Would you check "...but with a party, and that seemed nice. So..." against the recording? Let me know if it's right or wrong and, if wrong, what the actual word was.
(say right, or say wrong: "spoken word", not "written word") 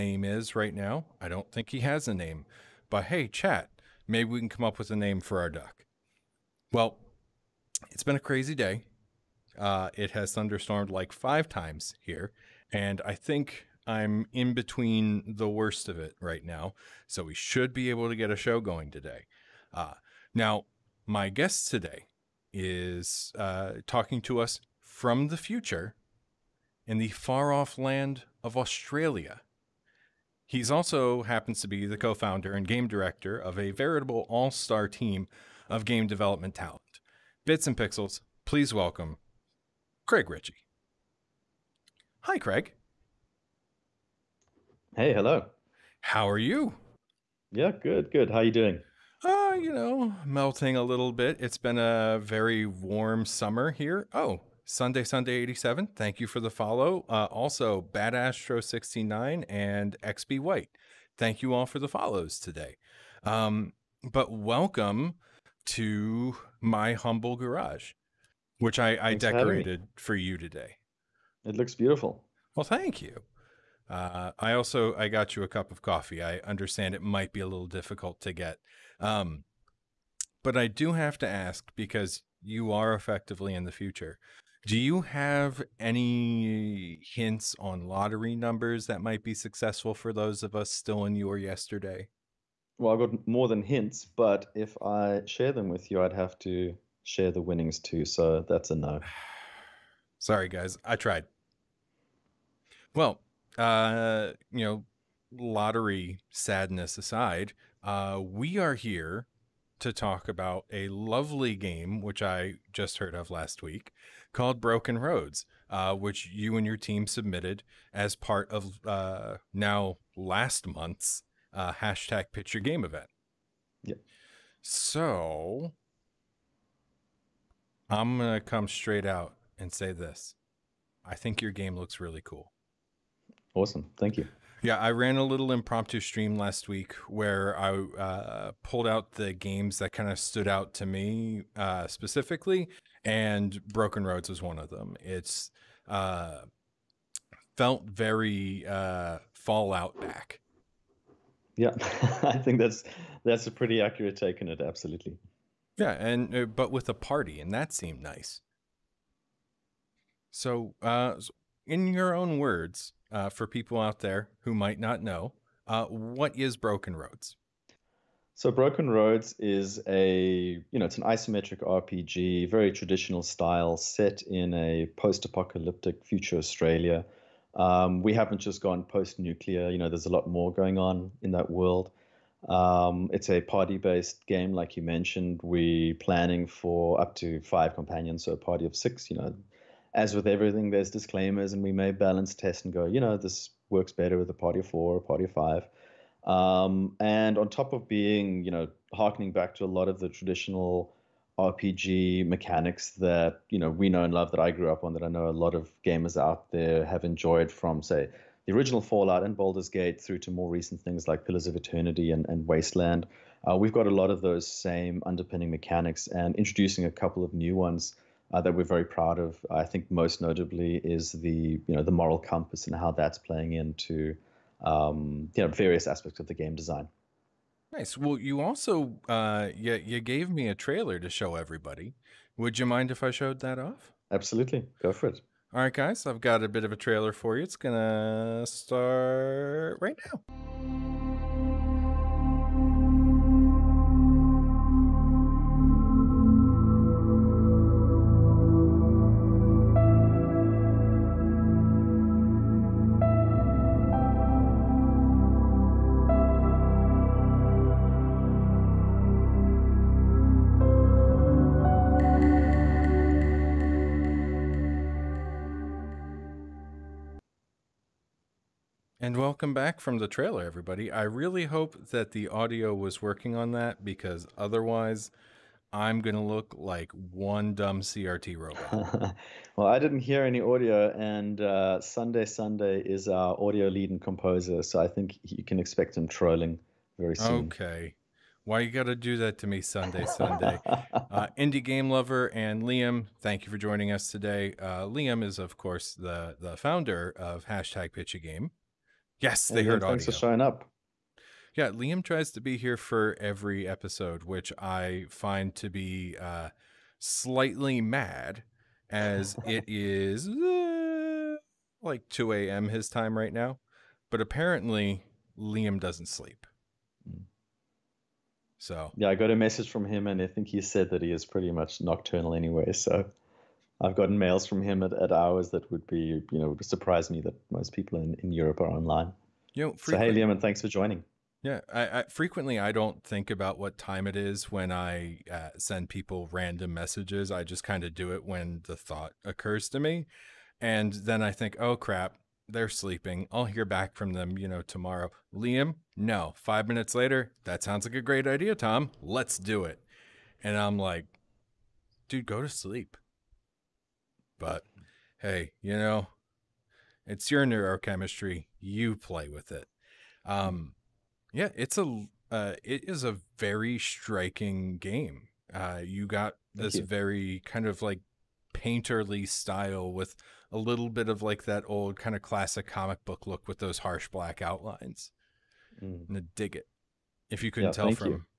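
right.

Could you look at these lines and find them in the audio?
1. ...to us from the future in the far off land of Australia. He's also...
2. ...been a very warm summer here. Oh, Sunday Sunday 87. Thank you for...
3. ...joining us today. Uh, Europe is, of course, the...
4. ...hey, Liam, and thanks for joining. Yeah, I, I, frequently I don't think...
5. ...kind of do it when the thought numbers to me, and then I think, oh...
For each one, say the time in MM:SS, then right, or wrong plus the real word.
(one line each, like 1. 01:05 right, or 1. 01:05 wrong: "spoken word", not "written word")
1. 00:24 right
2. 00:51 right
3. 04:53 wrong: "Liam", not "Europe"
4. 05:29 right
5. 05:37 wrong: "occurs", not "numbers".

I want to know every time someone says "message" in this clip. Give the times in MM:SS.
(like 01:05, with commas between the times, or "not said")
05:19, 05:36.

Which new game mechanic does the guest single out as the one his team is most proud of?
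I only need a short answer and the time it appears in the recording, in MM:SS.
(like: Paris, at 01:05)
moral compass, at 03:41.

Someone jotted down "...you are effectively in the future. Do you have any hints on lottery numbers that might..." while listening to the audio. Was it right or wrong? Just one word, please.
right.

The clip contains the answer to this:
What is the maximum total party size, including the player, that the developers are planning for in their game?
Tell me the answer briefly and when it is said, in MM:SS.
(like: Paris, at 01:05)
6, at 03:08.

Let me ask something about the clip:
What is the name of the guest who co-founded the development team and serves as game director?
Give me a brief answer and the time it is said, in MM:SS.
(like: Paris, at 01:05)
Craig Ritchie, at 00:40.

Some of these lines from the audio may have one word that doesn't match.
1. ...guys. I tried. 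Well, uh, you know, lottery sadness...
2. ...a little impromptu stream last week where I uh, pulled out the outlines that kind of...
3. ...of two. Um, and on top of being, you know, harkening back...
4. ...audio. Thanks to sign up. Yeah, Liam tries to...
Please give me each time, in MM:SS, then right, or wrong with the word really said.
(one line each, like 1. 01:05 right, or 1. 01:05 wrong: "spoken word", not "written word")
1. 01:40 right
2. 02:15 wrong: "games", not "outlines"
3. 03:15 wrong: "five", not "two"
4. 04:59 right.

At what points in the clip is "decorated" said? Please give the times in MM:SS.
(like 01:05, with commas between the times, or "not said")
01:09.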